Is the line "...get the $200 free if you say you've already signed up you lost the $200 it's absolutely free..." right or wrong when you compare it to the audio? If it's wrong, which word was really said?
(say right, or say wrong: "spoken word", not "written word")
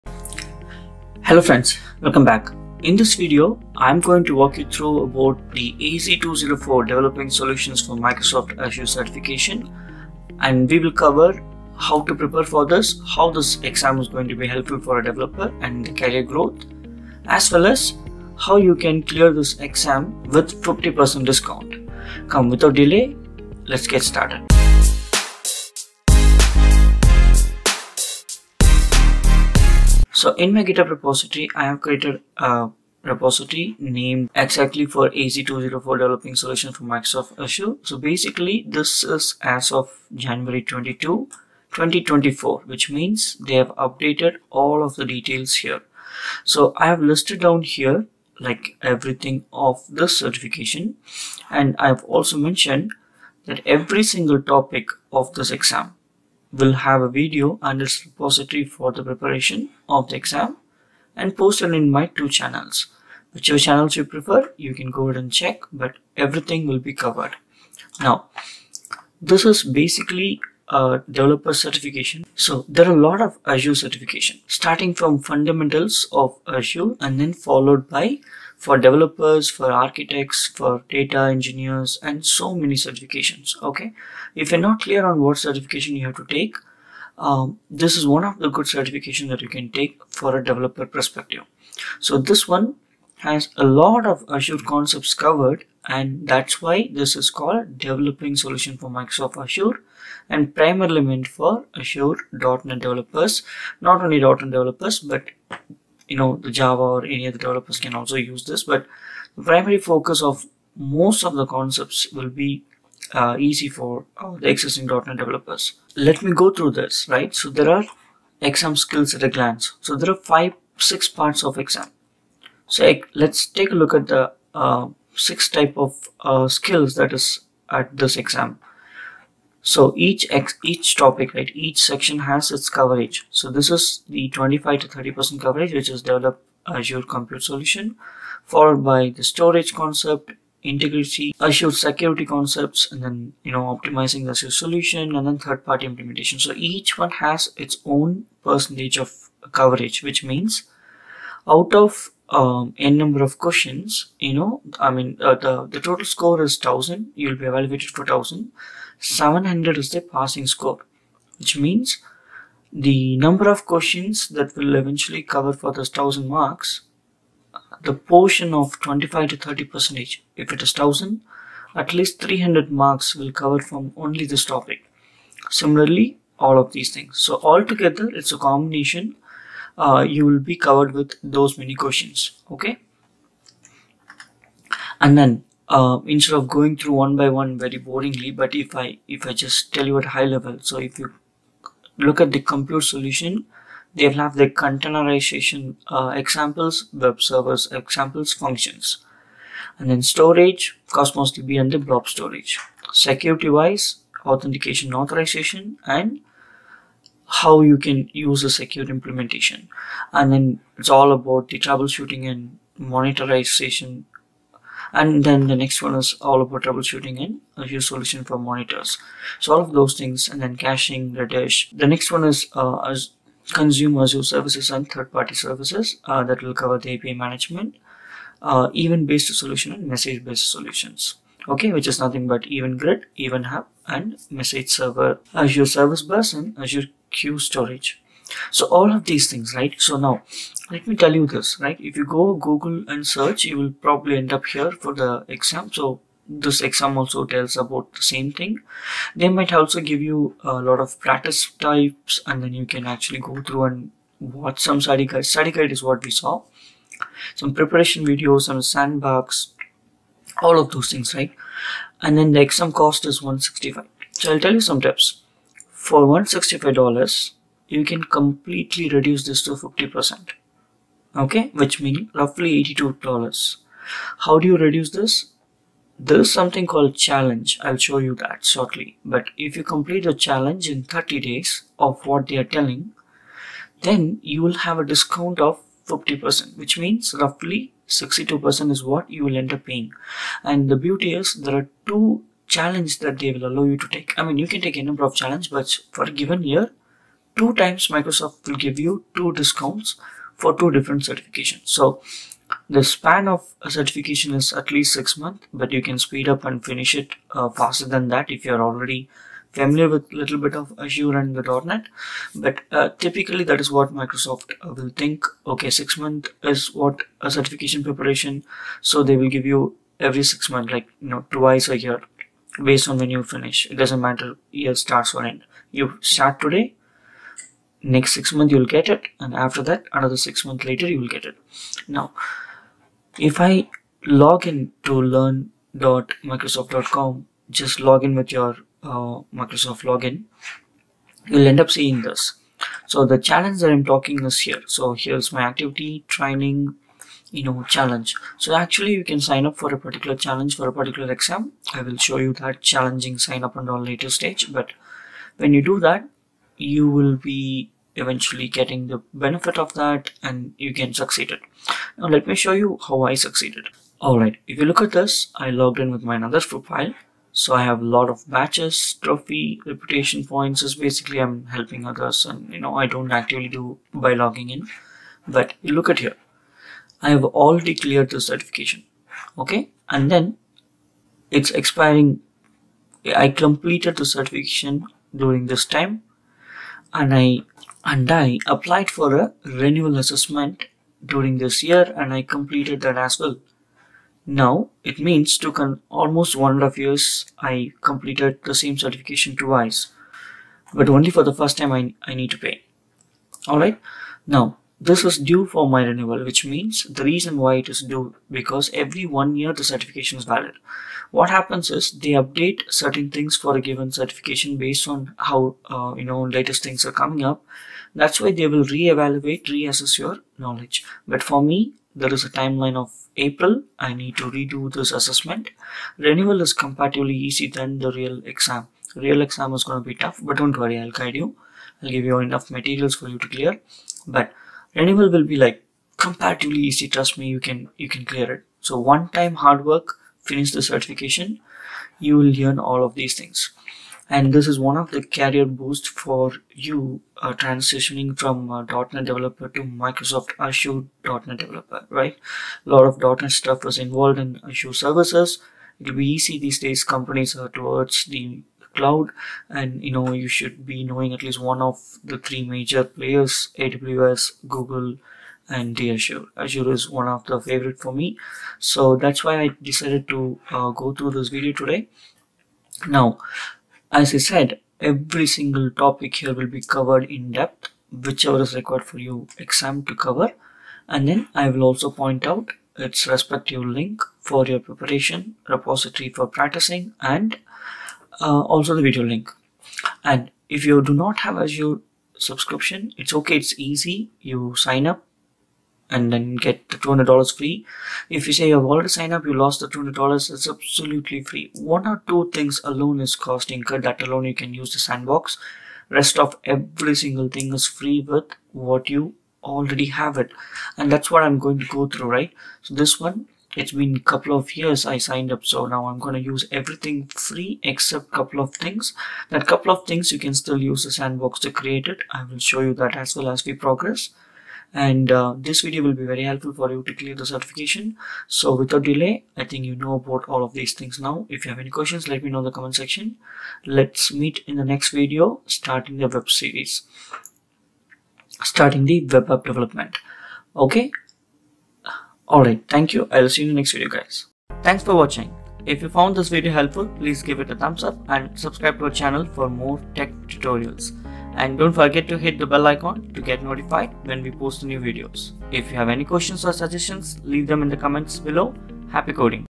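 right.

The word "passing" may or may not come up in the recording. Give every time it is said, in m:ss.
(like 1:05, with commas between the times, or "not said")
2:40.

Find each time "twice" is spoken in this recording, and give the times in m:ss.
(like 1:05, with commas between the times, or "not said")
5:21, 6:39.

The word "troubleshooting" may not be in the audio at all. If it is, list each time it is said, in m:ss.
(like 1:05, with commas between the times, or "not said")
3:31, 3:36.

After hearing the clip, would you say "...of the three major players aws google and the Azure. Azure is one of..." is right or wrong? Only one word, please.
right.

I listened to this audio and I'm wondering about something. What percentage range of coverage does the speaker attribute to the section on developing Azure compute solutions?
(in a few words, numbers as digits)
25 to 30 percent.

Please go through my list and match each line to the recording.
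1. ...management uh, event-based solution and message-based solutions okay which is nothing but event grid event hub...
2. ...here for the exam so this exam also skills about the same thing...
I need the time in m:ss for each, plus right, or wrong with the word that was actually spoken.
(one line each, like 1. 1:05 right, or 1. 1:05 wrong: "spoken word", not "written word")
1. 3:47 right
2. 4:04 wrong: "tells", not "skills".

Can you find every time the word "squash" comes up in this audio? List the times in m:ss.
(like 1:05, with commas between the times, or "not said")
not said.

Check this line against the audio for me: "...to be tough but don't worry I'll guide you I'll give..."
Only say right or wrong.
right.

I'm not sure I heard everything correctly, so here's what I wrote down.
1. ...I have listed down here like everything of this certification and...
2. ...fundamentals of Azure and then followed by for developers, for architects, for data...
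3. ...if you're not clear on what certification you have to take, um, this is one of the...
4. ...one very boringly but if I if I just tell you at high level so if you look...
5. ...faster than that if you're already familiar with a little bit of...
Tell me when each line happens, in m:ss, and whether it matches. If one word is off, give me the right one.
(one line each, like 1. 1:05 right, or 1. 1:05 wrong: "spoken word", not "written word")
1. 0:46 right
2. 1:15 right
3. 1:24 right
4. 3:07 right
5. 5:07 right.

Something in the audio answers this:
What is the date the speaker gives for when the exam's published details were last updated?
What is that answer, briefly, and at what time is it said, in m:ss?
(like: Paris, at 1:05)
January 22, 2024, at 0:40.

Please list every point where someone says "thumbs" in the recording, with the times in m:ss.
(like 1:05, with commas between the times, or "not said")
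9:07.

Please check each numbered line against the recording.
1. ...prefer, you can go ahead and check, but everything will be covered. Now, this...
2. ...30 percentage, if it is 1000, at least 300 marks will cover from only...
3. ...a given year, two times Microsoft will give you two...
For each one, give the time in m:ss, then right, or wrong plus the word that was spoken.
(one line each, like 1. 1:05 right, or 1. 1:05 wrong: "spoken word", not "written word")
1. 1:04 right
2. 2:49 right
3. 4:56 right.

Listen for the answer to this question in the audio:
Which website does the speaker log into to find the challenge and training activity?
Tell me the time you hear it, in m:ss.
5:35.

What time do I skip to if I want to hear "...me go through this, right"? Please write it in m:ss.
1:56.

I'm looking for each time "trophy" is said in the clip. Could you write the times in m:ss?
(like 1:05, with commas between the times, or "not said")
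6:09.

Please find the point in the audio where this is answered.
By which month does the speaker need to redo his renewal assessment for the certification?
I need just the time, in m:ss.
7:03.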